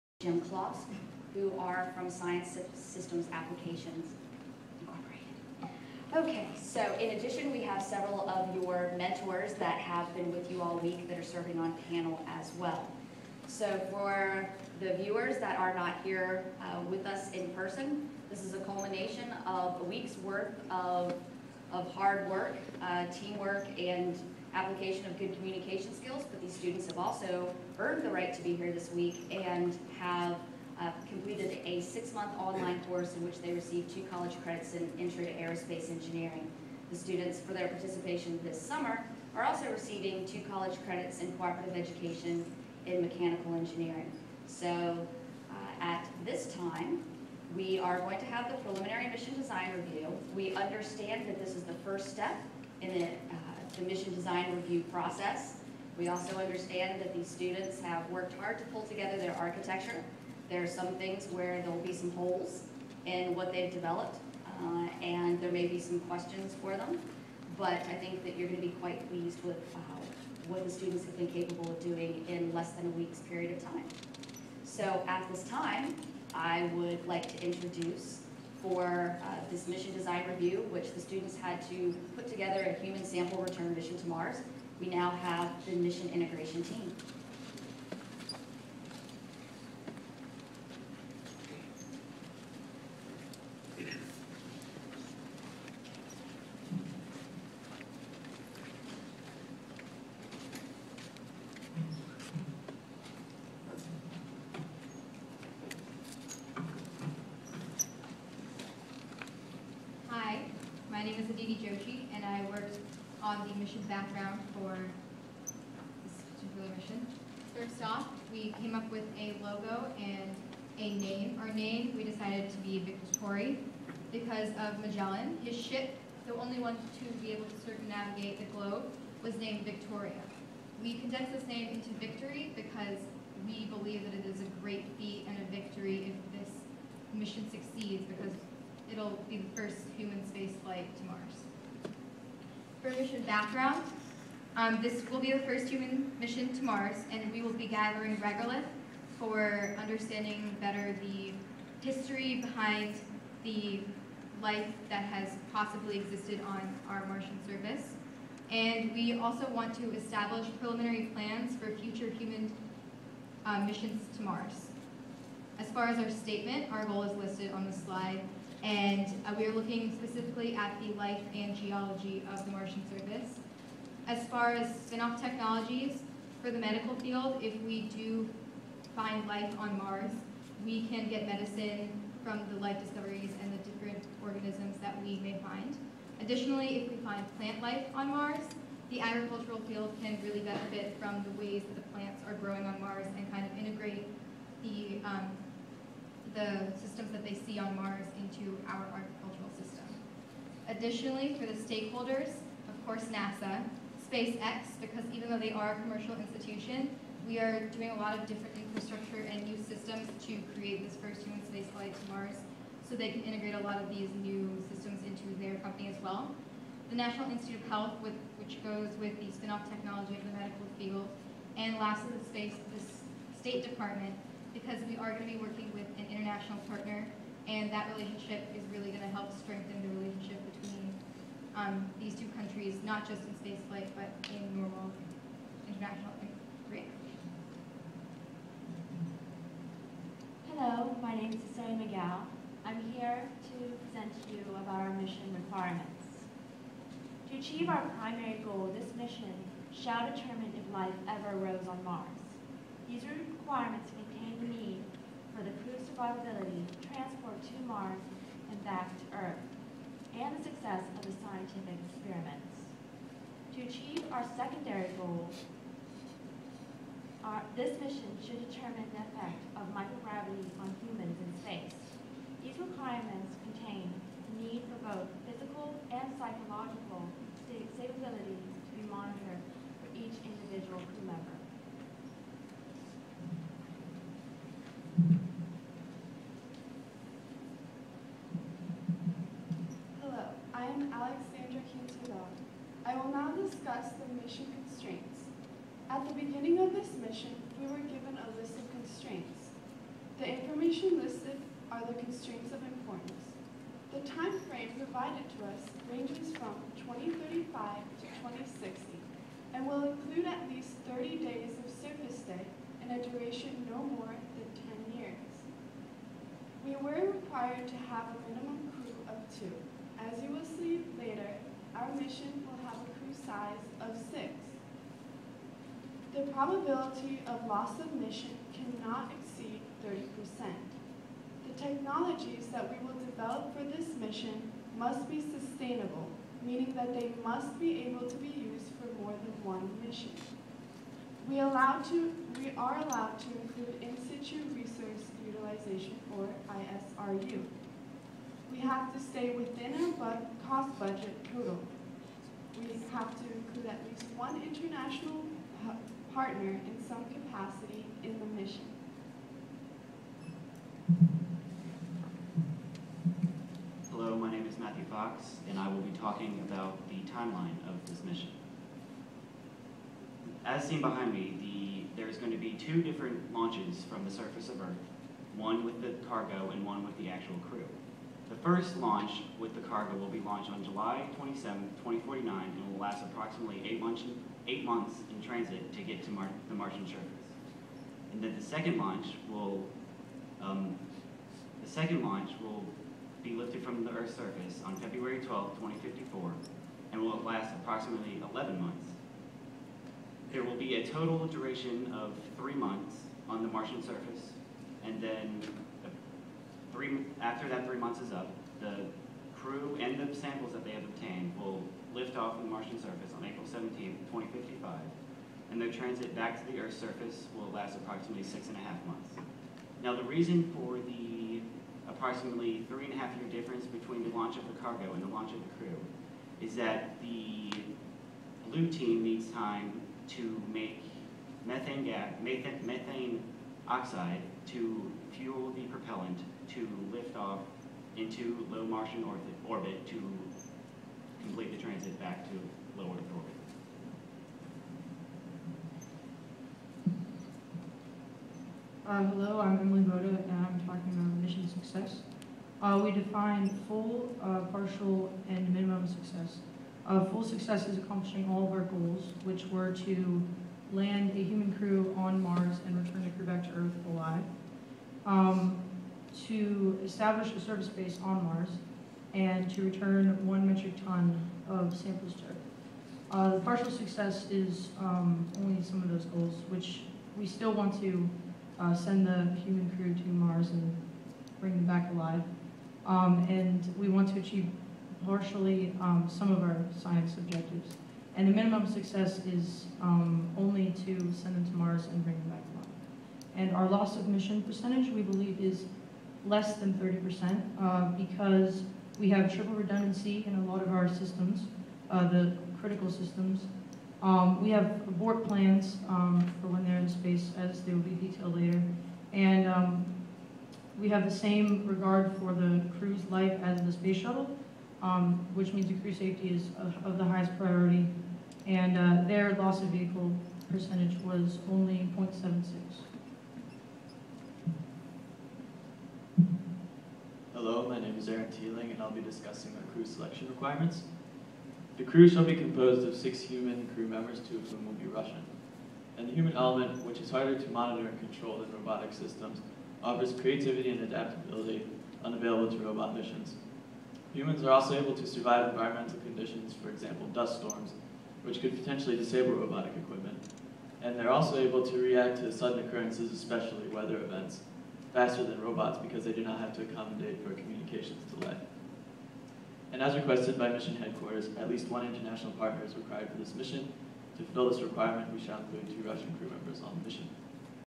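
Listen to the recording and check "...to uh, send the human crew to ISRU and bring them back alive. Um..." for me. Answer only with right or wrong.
wrong.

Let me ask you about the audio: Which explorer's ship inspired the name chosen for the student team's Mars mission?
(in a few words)
Magellan.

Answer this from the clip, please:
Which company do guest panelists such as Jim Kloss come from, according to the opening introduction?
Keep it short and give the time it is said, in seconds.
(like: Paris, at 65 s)
Science Systems Applications Incorporated, at 2 s.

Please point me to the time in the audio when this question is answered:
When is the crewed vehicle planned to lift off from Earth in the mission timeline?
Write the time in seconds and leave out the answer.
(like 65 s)
394 s.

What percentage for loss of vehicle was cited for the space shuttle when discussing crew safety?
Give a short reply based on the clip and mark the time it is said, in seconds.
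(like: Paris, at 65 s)
0.76, at 521 s.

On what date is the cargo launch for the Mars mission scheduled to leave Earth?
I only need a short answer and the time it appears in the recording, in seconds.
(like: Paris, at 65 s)
July 27, 2049, at 380 s.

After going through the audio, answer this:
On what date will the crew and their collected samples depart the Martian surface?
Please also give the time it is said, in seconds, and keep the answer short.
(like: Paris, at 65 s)
April 17, 2055, at 413 s.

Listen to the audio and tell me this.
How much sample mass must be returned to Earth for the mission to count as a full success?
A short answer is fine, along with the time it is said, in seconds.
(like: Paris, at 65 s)
1 metric ton, at 470 s.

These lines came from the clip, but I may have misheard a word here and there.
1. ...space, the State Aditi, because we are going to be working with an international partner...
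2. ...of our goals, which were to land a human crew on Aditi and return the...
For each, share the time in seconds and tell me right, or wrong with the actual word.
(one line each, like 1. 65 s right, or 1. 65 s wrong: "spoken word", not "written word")
1. 222 s wrong: "Department", not "Aditi"
2. 458 s wrong: "Mars", not "Aditi".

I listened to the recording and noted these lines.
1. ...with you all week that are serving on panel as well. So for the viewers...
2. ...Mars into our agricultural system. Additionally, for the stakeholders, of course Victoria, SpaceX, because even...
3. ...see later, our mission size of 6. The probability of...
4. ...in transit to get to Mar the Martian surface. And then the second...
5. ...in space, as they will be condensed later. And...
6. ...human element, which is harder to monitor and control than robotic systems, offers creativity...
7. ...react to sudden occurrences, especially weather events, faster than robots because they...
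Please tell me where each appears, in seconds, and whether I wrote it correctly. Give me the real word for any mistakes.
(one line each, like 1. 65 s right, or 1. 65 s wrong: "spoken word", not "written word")
1. 10 s right
2. 197 s wrong: "NASA", not "Victoria"
3. 320 s right
4. 385 s right
5. 506 s wrong: "detailed", not "condensed"
6. 536 s right
7. 551 s right.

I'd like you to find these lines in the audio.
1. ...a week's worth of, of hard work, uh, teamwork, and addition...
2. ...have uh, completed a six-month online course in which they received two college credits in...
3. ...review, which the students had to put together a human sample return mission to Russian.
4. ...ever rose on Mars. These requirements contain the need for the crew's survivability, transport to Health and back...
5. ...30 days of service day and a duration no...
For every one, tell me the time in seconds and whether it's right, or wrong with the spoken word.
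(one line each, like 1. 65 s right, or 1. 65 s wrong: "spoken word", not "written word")
1. 19 s wrong: "application", not "addition"
2. 29 s right
3. 80 s wrong: "Mars", not "Russian"
4. 251 s wrong: "Mars", not "Health"
5. 310 s right.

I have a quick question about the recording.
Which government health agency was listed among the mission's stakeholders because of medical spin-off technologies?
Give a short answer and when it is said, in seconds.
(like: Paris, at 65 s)
National Institute of Health, at 216 s.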